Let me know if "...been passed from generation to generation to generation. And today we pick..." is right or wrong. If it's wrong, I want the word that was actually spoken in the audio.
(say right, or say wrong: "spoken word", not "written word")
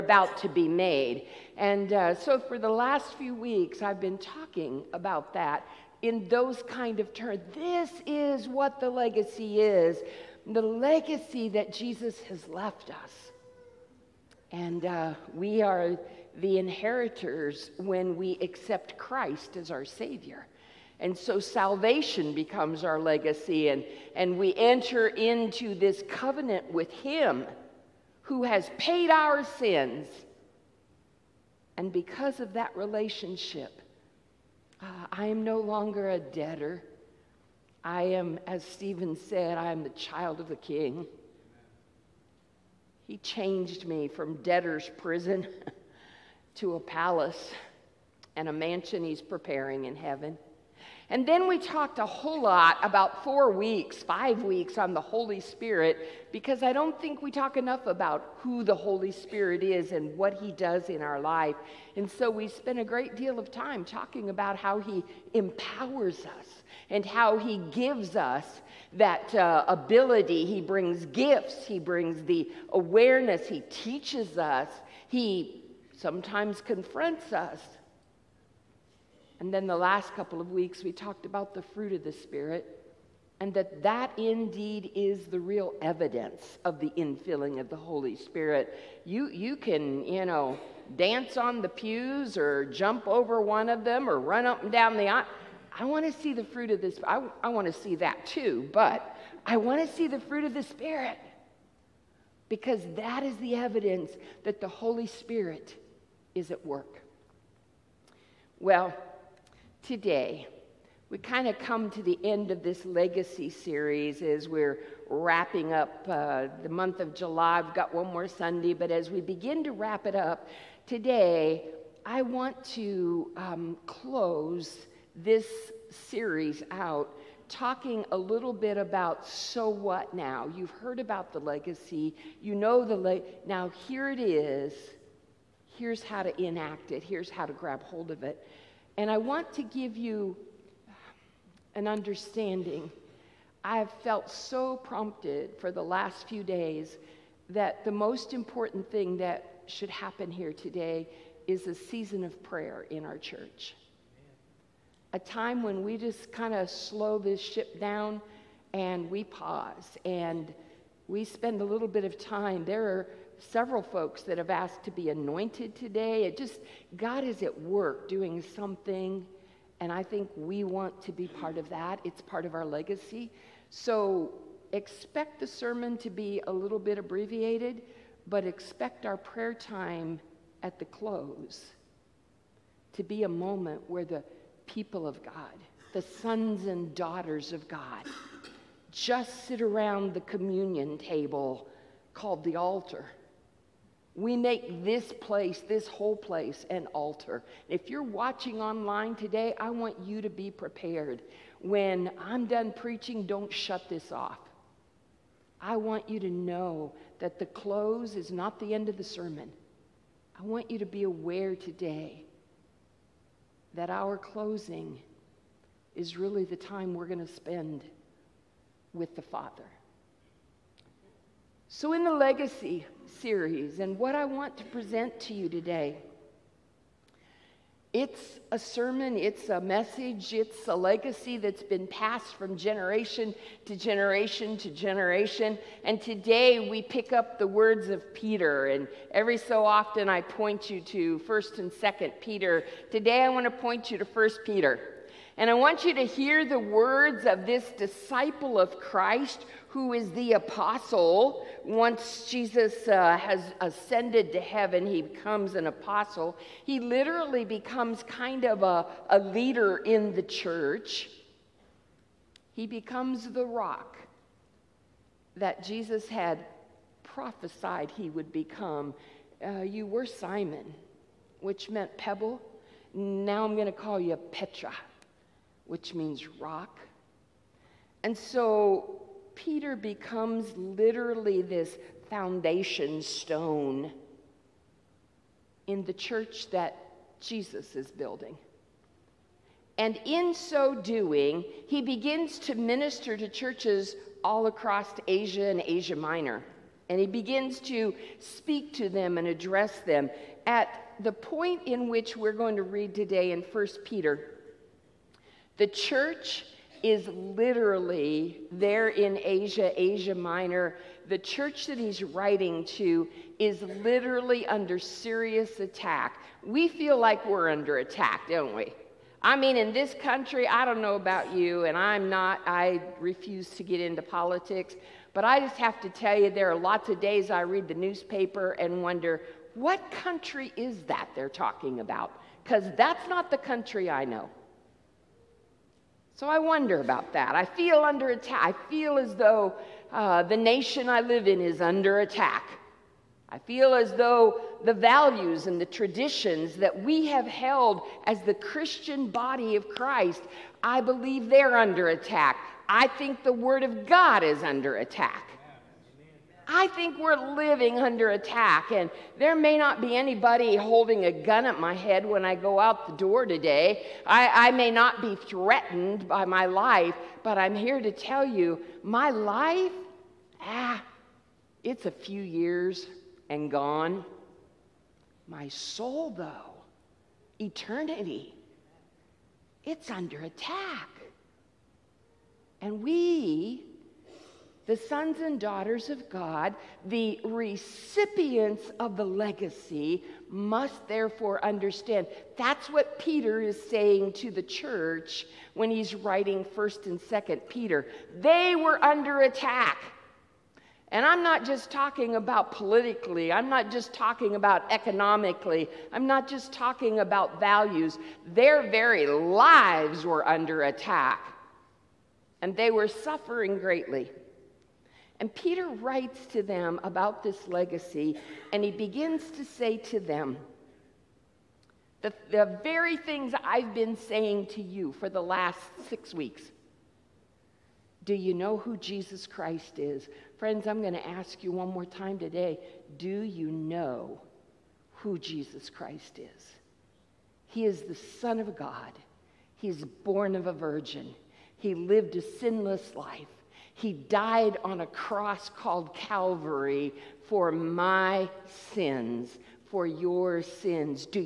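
right.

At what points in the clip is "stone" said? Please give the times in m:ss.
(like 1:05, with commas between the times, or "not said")
4:43.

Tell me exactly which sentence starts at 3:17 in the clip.
If you're watching online today, I want you to be prepared.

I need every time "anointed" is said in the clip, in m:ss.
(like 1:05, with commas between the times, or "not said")
2:45.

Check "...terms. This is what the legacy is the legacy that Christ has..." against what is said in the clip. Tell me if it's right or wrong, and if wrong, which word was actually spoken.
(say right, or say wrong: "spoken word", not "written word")
wrong: "Jesus", not "Christ".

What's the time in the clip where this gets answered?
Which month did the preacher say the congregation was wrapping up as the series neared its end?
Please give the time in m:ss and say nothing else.
1:57.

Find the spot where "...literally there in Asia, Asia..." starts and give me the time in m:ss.
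5:07.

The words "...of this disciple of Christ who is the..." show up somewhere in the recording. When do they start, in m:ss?
4:07.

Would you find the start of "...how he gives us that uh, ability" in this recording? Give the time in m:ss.
1:07.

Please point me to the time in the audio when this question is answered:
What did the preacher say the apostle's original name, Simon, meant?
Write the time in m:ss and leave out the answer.
4:31.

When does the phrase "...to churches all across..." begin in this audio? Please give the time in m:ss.
4:53.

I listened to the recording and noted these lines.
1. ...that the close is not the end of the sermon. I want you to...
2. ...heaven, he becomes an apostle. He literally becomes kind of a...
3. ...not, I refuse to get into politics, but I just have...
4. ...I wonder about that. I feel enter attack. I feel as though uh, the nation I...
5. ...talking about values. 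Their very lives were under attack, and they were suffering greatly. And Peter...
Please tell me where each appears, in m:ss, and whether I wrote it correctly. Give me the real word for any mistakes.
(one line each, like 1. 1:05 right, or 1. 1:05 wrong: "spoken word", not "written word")
1. 3:27 right
2. 4:14 right
3. 5:22 right
4. 5:36 wrong: "under", not "enter"
5. 6:46 right.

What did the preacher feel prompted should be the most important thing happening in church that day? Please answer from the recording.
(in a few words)
A season of prayer.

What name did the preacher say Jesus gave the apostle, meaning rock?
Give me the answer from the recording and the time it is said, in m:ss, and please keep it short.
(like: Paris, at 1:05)
Petra, at 4:34.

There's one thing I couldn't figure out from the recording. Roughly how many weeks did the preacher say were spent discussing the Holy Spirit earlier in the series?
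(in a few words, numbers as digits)
5.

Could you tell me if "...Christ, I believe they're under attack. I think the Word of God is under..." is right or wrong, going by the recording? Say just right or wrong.
right.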